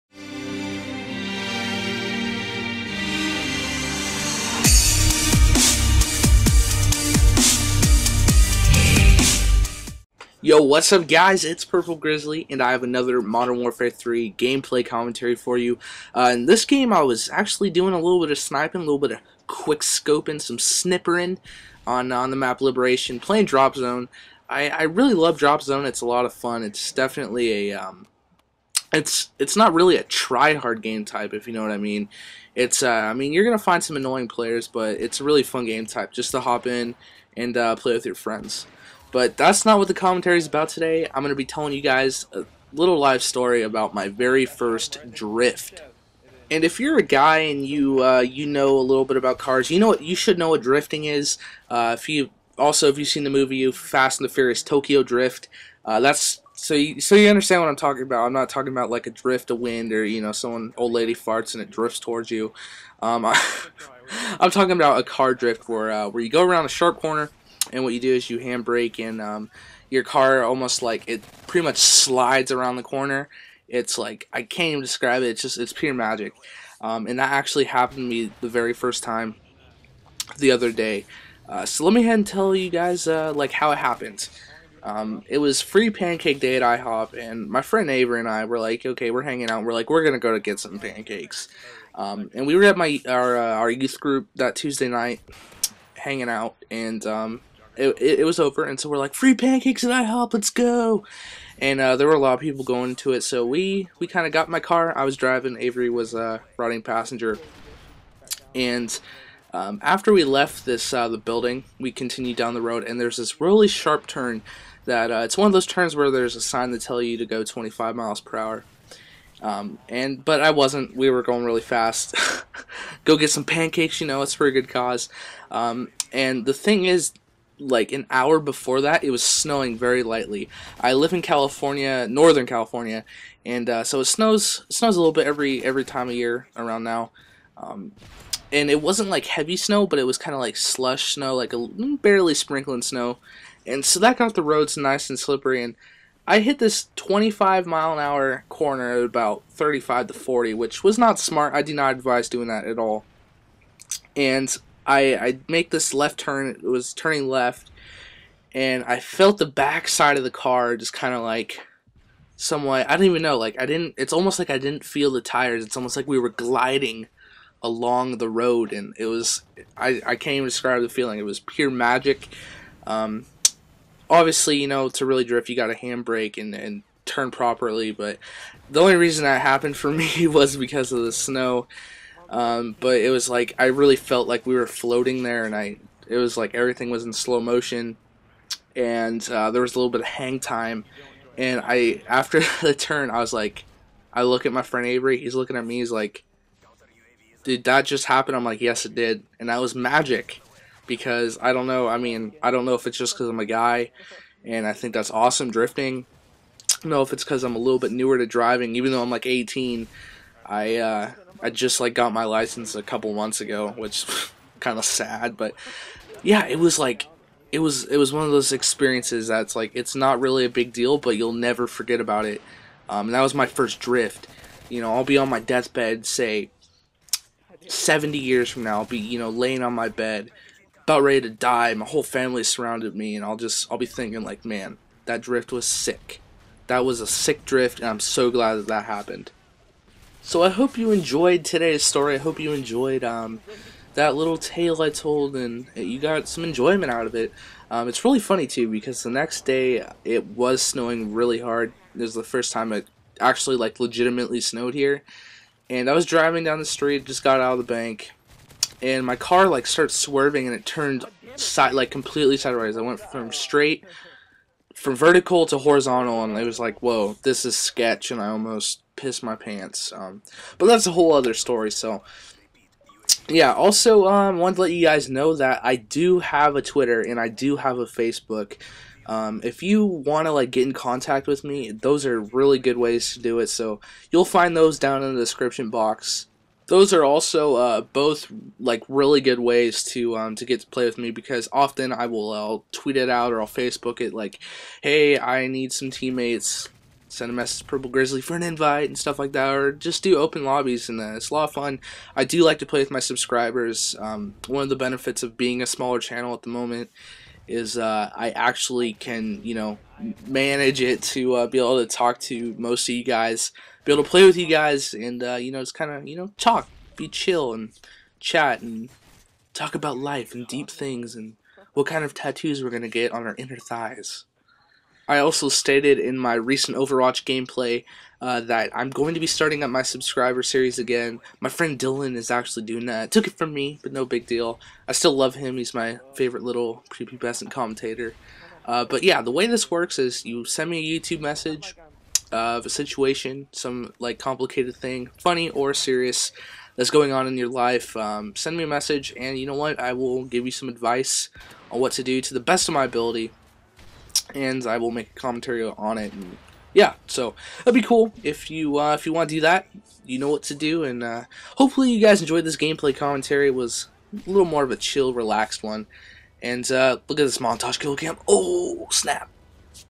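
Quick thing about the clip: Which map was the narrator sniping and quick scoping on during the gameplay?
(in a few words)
Liberation.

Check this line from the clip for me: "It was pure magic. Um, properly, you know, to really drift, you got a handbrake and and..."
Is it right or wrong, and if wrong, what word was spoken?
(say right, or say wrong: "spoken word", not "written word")
wrong: "obviously", not "properly".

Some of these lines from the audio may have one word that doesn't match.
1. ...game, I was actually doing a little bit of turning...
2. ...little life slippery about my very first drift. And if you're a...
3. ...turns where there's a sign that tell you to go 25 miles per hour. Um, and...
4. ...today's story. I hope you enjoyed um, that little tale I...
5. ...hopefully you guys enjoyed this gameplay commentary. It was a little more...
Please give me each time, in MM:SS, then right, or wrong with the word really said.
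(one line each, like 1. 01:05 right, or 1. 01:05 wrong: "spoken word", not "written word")
1. 00:16 wrong: "sniping", not "turning"
2. 00:42 wrong: "story", not "slippery"
3. 01:55 right
4. 04:01 right
5. 06:01 right.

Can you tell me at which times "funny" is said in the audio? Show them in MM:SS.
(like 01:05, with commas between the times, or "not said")
04:08, 05:45.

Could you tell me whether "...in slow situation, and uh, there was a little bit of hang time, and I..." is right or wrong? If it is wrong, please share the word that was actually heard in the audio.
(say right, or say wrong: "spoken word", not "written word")
wrong: "motion", not "situation".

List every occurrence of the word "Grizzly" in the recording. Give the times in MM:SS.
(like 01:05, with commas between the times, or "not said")
00:11, 04:57.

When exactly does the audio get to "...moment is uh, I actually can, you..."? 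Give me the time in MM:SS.
05:06.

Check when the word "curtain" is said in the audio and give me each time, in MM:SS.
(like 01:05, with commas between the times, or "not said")
not said.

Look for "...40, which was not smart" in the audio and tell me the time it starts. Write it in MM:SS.
02:30.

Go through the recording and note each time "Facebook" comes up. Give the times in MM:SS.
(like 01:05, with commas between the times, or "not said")
04:37, 04:53.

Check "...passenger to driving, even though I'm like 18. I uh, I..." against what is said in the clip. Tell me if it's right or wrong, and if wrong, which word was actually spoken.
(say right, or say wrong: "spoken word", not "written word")
wrong: "newer", not "passenger".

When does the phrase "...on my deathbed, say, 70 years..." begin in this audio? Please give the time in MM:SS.
03:45.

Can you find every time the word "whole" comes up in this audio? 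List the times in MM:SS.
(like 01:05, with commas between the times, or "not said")
03:51, 04:30.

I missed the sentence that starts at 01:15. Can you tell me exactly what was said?
It's just it's pure magic, um, and that actually happened to me the very first time the other day.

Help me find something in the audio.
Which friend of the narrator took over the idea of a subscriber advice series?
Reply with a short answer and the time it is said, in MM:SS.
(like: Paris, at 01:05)
Dylan, at 05:31.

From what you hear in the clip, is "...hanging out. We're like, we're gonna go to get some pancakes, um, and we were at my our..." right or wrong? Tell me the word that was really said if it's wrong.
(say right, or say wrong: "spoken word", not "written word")
right.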